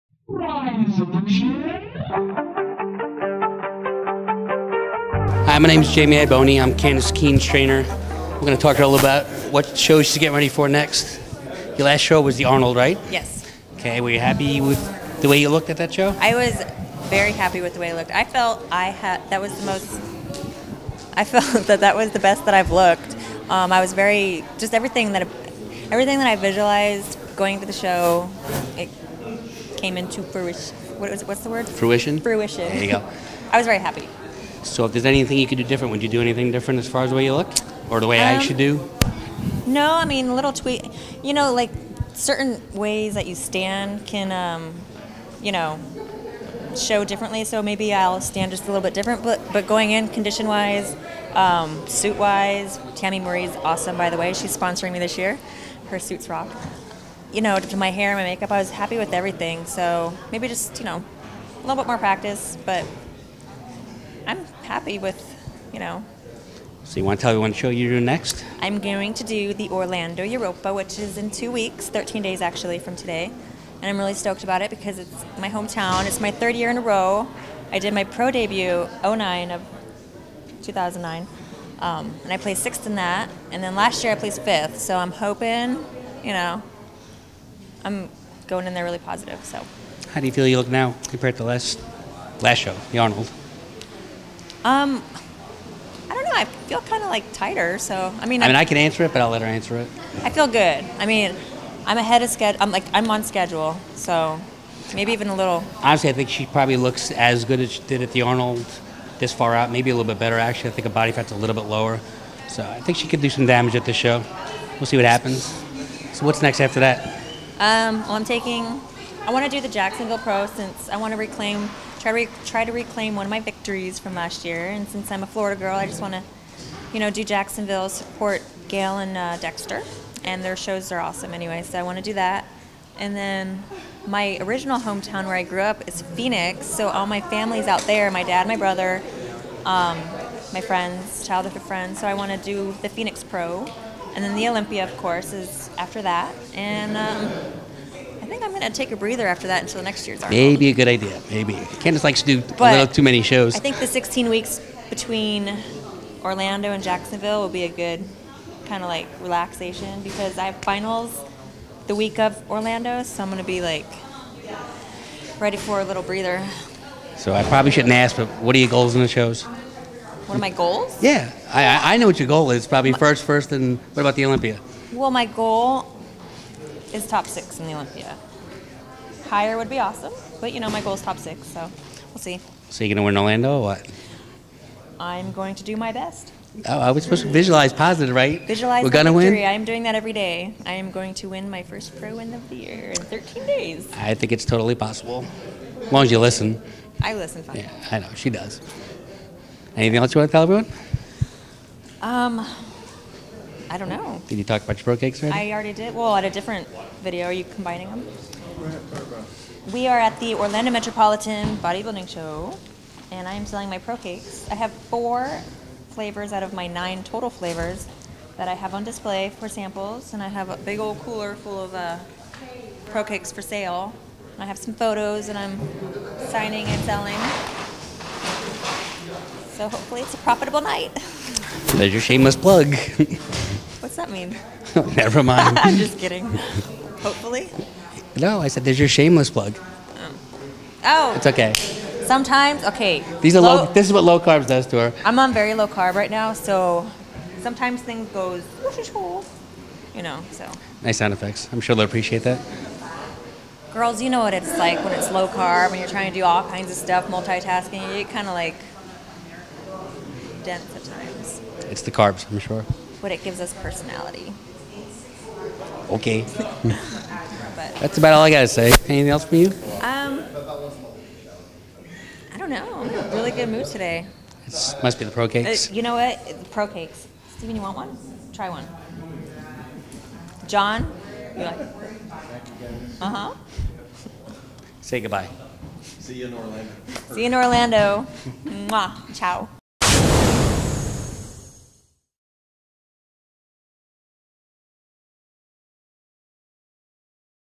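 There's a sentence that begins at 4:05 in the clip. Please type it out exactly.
I'm on very low carb right now, so sometimes things goes, you know.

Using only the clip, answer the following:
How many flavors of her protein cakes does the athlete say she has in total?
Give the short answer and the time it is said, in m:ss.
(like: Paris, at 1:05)
9, at 3:36.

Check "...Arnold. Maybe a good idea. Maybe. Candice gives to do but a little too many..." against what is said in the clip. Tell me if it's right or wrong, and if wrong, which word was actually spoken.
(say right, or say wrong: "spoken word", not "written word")
wrong: "likes", not "gives".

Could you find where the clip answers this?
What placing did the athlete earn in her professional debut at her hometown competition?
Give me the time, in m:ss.
1:22.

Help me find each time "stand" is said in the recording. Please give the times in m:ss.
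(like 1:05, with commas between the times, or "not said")
0:43, 0:48.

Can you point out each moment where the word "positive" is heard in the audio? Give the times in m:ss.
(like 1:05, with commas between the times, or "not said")
1:28, 3:07.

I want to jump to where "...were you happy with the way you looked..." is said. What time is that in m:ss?
0:14.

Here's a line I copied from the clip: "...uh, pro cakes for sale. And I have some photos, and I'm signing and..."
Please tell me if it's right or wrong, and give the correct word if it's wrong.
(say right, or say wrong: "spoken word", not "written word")
right.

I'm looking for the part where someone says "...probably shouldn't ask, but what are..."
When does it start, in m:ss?
2:47.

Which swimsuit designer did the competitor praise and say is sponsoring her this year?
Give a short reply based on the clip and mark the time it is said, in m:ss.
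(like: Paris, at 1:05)
Tammy Murray, at 0:52.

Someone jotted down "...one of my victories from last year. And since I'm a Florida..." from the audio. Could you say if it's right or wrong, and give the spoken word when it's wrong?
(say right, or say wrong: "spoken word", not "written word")
right.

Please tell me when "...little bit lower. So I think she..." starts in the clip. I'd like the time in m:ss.
1:51.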